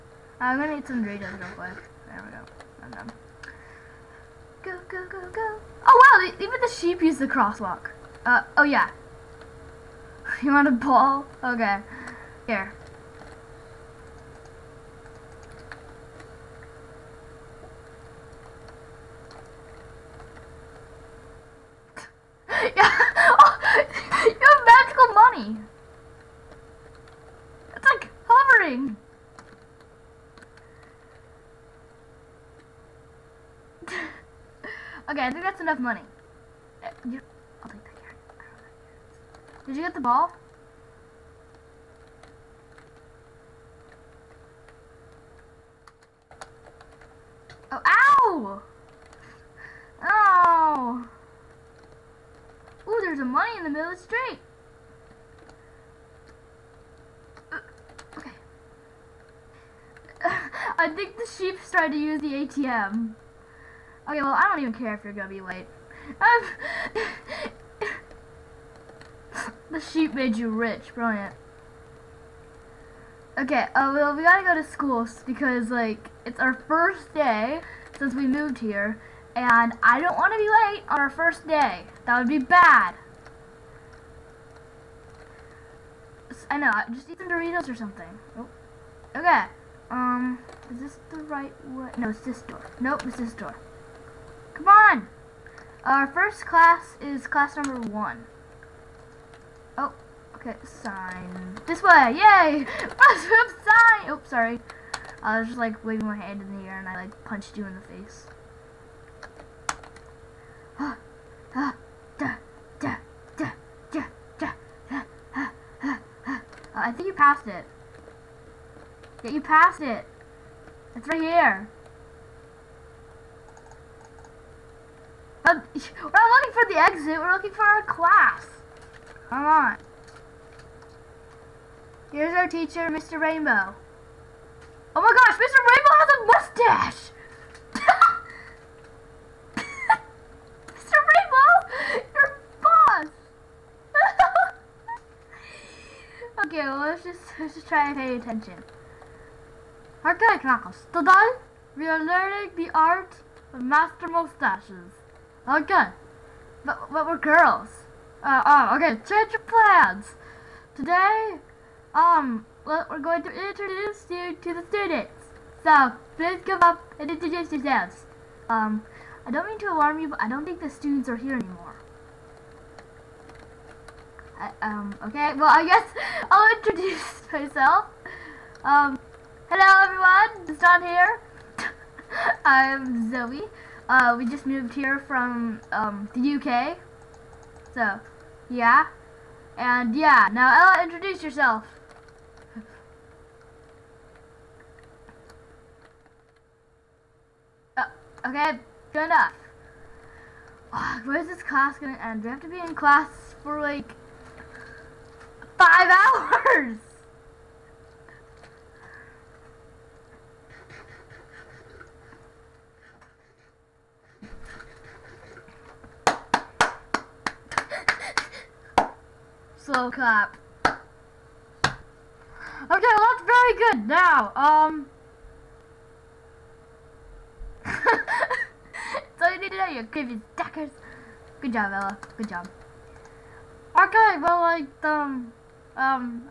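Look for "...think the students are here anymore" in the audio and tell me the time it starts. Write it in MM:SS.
02:50.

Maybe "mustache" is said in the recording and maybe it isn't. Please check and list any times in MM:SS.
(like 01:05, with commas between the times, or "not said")
02:16, 02:34.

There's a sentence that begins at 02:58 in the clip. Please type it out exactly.
Um, hello everyone, it's Don here.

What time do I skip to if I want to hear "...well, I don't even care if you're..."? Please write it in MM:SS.
01:04.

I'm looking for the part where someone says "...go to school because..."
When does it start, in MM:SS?
01:14.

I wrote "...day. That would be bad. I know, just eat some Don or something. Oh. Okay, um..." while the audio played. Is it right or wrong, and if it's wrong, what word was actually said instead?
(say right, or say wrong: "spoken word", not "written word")
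wrong: "Doritos", not "Don".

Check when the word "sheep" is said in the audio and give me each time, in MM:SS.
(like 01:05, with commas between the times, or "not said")
00:06, 01:01, 01:09.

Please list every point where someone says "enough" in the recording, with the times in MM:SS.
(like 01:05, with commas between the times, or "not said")
00:35, 03:19.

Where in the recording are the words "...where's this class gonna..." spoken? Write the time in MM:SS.
03:21.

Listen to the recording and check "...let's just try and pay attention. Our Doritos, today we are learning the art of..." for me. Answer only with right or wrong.
wrong.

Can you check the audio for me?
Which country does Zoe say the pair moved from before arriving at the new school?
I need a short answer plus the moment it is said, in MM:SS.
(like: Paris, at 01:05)
The UK, at 03:06.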